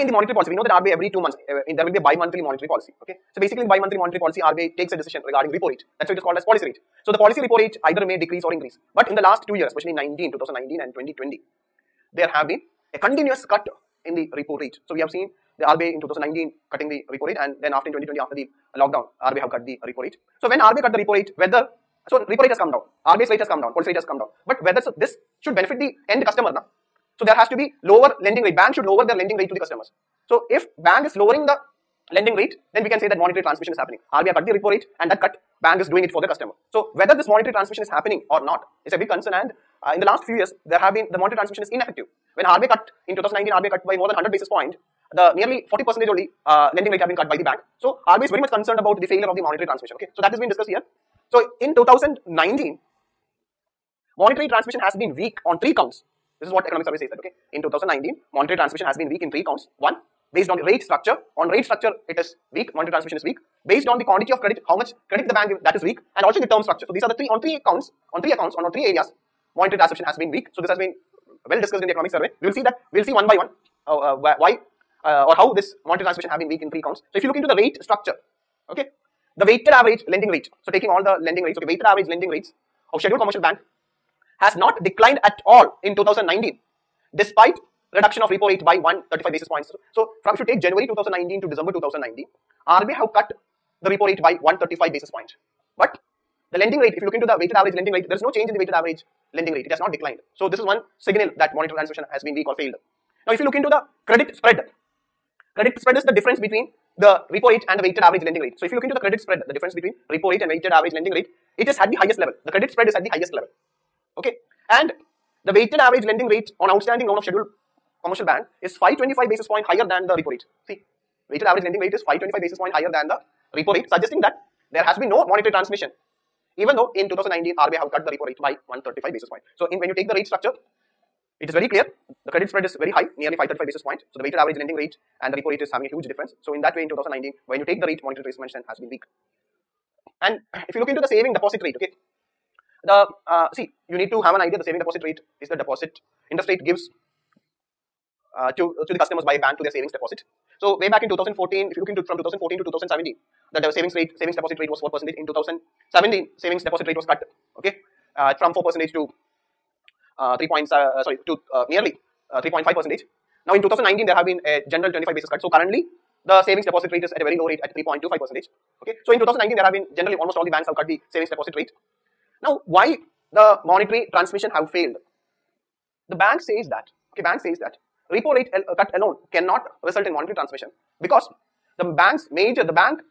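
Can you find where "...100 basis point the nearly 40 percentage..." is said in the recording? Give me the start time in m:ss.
0:44.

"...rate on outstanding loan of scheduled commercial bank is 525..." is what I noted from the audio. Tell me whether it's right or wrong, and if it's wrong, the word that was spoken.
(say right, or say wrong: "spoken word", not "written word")
right.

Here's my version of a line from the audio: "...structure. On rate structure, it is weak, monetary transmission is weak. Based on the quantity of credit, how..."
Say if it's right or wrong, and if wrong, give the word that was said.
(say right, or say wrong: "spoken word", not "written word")
right.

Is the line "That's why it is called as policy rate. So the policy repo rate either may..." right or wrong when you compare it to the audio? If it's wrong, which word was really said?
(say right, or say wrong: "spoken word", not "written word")
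right.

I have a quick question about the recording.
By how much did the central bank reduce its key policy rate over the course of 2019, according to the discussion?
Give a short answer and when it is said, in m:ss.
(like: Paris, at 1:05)
135 basis points, at 1:28.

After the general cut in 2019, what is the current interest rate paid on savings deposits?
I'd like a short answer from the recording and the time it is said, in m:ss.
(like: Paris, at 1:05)
3.25 percent, at 2:47.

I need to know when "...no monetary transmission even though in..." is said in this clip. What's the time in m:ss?
2:05.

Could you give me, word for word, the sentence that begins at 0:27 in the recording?
So there has to be lower lending rate.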